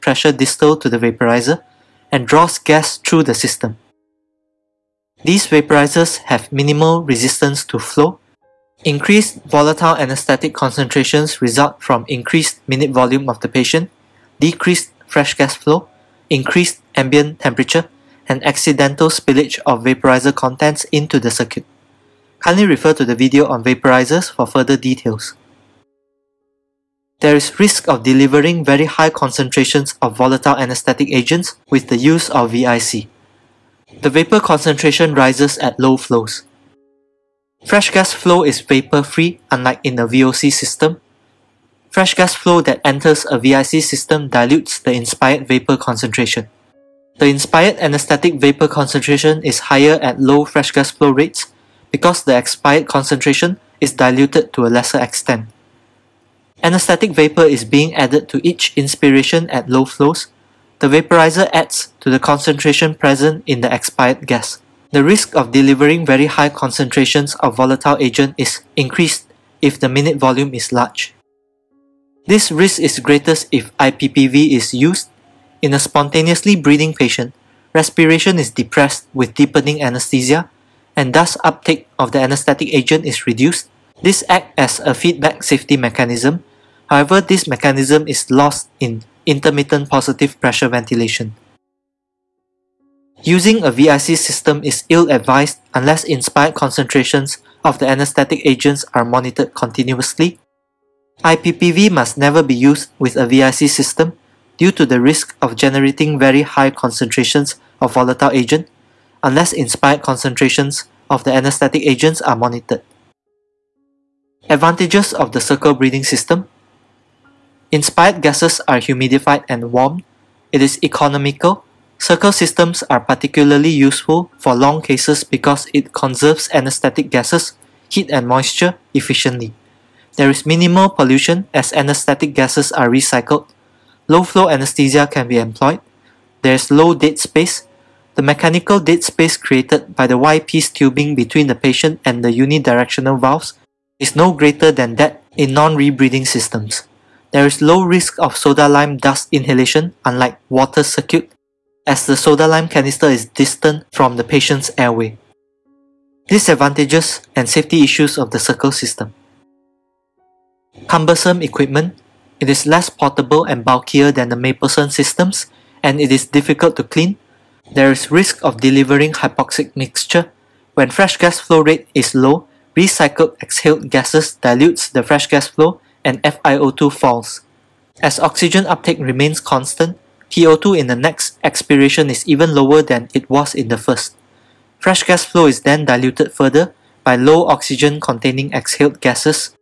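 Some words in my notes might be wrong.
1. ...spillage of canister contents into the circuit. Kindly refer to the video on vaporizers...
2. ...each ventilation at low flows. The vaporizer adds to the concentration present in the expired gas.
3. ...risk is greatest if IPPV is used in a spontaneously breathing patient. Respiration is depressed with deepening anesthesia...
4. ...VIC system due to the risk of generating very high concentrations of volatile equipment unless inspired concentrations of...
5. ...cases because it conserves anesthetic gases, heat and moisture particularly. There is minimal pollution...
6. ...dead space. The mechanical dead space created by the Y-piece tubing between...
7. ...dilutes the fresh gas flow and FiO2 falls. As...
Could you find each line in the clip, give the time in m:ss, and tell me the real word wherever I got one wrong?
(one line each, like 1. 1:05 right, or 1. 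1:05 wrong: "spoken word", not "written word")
1. 0:19 wrong: "vaporizer", not "canister"
2. 0:58 wrong: "inspiration", not "ventilation"
3. 1:12 right
4. 1:43 wrong: "agent", not "equipment"
5. 2:04 wrong: "efficiently", not "particularly"
6. 2:16 right
7. 2:54 right.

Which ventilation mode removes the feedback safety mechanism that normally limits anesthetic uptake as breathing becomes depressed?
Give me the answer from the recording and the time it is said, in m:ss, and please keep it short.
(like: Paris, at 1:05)
Intermittent positive pressure ventilation, at 1:29.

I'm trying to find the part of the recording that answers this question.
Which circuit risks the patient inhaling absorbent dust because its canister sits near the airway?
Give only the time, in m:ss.
2:30.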